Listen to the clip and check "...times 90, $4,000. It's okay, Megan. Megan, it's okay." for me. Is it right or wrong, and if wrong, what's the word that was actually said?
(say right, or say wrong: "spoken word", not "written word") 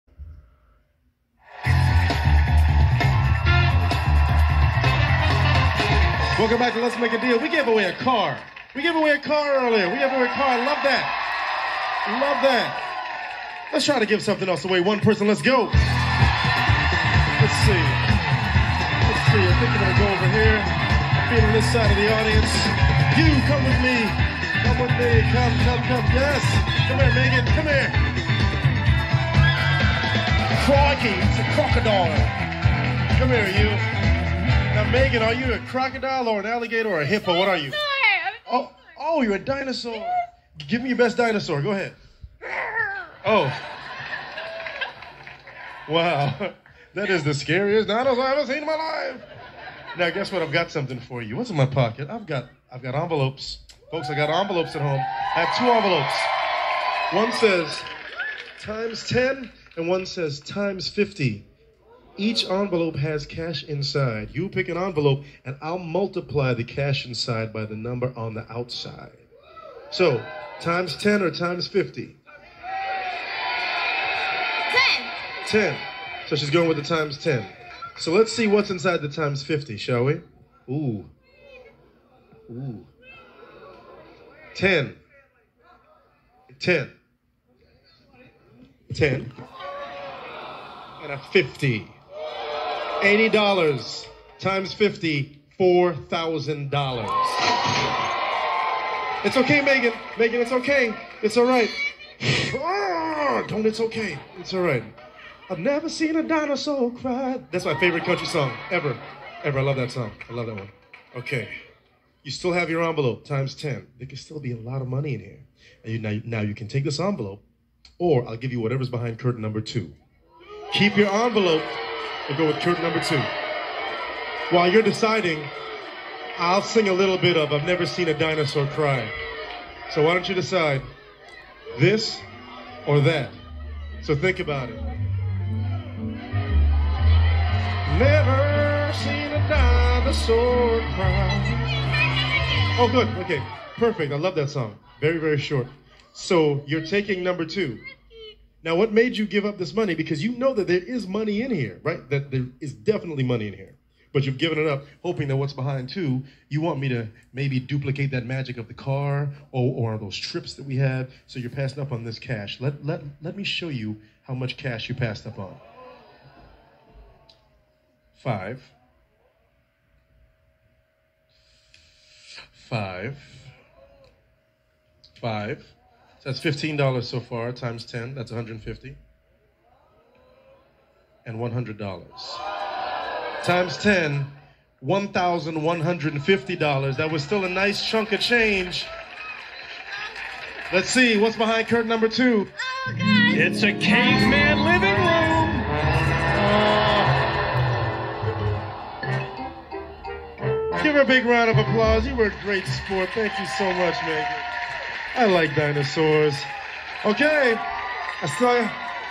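wrong: "50", not "90".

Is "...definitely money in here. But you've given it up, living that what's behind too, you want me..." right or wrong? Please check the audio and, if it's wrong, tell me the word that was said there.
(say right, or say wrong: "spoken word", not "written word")
wrong: "hoping", not "living".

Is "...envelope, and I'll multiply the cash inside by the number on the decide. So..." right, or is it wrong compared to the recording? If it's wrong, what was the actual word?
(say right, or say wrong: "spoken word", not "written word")
wrong: "outside", not "decide".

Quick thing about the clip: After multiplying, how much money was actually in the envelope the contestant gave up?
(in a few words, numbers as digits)
$1,150.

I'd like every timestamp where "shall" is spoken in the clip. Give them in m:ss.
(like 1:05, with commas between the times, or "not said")
1:19.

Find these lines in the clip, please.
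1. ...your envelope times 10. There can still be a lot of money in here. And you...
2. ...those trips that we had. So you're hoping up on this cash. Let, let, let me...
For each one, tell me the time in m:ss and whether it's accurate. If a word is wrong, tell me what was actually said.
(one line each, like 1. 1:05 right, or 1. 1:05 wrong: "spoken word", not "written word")
1. 1:52 right
2. 2:39 wrong: "passing", not "hoping".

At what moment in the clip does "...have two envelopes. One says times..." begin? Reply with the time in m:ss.
0:55.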